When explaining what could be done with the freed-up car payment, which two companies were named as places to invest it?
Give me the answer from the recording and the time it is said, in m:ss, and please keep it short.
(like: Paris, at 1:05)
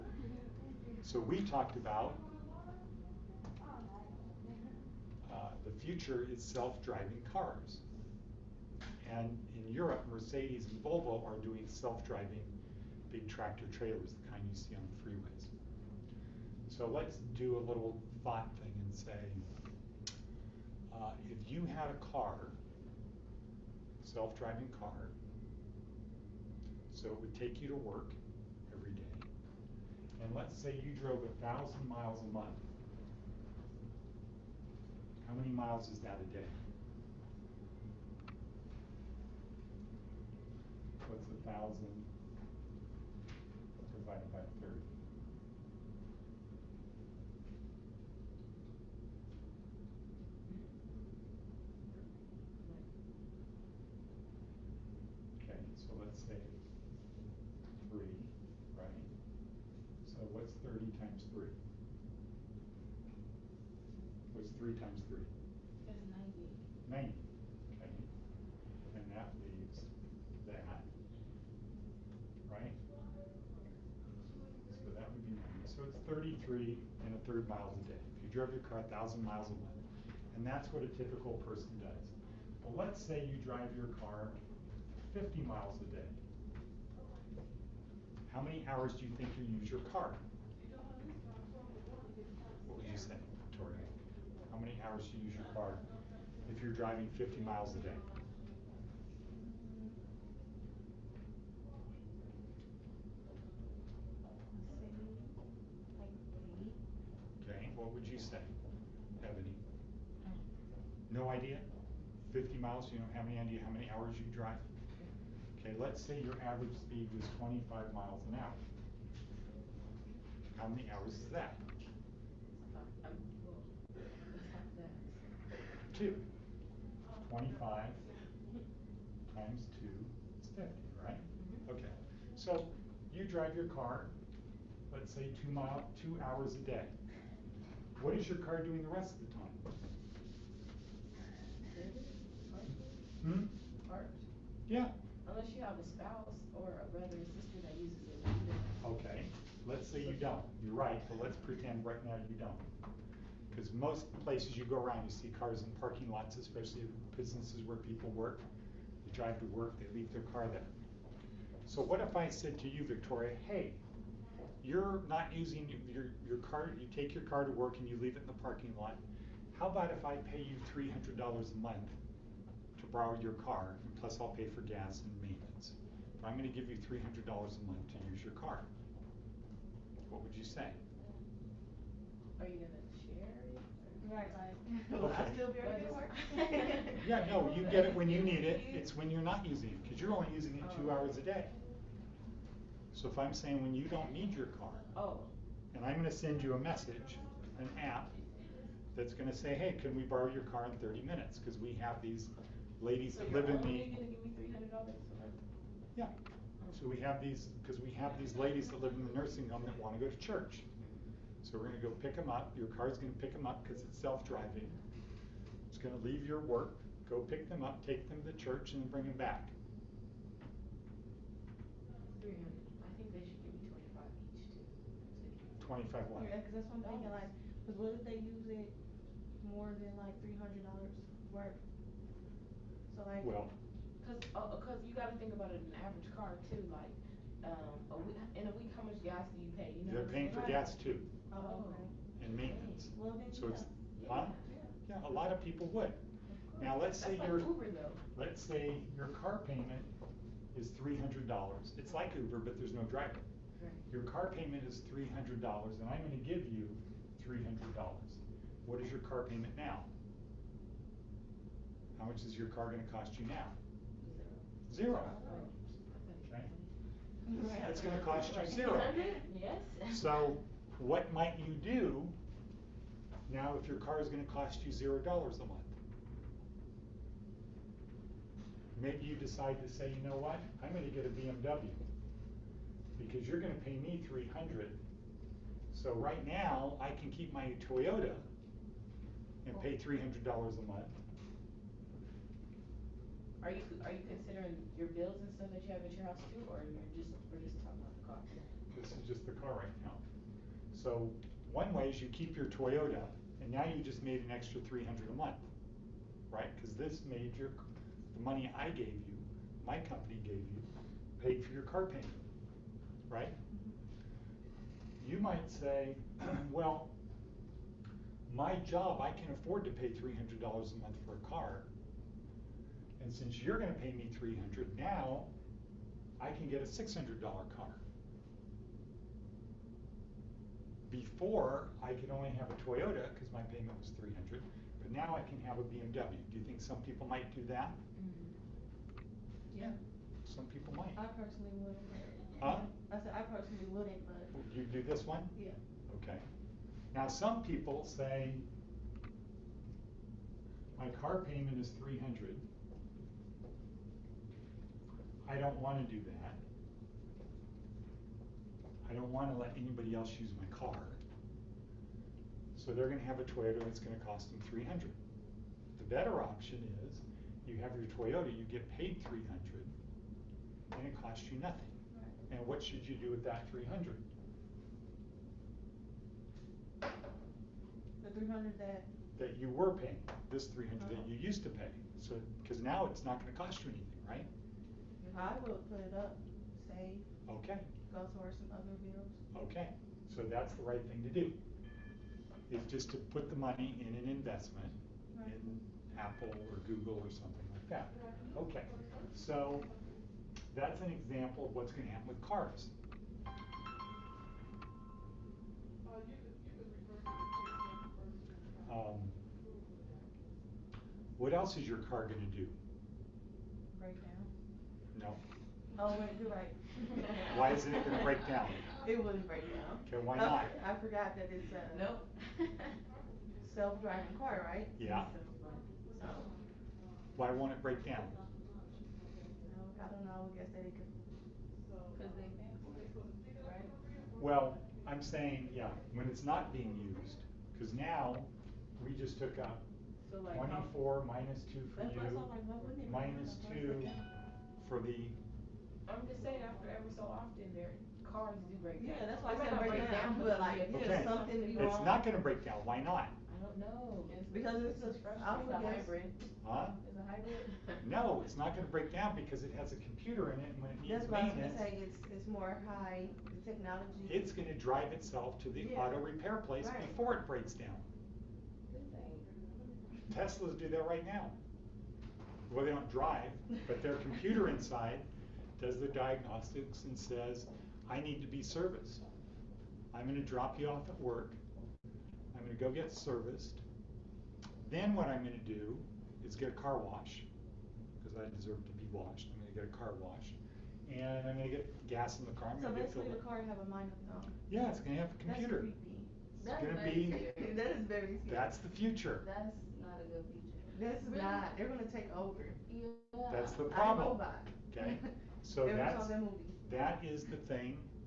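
Apple or Google, at 6:35.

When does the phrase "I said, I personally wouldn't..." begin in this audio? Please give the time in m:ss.
5:42.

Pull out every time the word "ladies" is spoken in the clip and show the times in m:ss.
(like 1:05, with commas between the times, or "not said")
3:22, 3:28.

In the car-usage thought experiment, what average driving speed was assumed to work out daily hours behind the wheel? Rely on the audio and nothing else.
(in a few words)
25 miles an hour.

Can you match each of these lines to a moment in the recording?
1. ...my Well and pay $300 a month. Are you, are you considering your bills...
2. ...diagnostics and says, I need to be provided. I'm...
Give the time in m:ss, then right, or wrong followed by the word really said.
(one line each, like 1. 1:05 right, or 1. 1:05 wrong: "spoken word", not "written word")
1. 4:47 wrong: "Toyota", not "Well"
2. 7:55 wrong: "serviced", not "provided".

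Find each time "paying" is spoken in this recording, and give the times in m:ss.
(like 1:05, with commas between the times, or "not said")
4:00, 6:19.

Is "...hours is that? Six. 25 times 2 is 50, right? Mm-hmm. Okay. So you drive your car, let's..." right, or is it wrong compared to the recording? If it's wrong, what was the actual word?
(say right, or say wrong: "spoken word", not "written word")
wrong: "Two", not "Six".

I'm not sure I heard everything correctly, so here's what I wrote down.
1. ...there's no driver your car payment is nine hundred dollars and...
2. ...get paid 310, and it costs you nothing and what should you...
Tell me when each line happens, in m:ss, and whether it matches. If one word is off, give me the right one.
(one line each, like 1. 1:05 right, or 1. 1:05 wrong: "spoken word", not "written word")
1. 4:12 wrong: "three", not "nine"
2. 6:08 wrong: "300", not "310".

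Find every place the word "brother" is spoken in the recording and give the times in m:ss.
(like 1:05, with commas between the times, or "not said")
2:26.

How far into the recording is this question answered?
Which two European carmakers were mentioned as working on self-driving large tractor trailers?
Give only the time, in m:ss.
0:10.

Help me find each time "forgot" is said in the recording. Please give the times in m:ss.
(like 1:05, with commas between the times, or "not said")
7:00.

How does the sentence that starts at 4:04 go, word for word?
Yeah, a lot of people would.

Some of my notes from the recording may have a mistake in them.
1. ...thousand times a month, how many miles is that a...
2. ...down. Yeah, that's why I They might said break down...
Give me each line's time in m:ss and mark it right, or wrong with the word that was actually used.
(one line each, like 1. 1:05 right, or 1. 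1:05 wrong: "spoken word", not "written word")
1. 0:31 wrong: "miles", not "times"
2. 7:28 right.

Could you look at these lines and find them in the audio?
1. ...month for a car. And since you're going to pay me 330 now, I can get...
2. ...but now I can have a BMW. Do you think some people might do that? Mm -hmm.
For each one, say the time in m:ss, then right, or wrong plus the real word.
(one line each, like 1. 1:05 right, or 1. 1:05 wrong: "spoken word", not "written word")
1. 5:20 wrong: "300", not "330"
2. 5:34 right.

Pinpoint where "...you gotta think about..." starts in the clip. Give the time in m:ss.
3:54.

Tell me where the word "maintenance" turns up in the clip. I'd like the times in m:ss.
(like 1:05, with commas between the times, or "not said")
2:55, 4:02, 7:41.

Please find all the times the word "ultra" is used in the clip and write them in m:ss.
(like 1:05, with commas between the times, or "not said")
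not said.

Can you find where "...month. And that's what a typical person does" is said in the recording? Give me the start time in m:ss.
1:19.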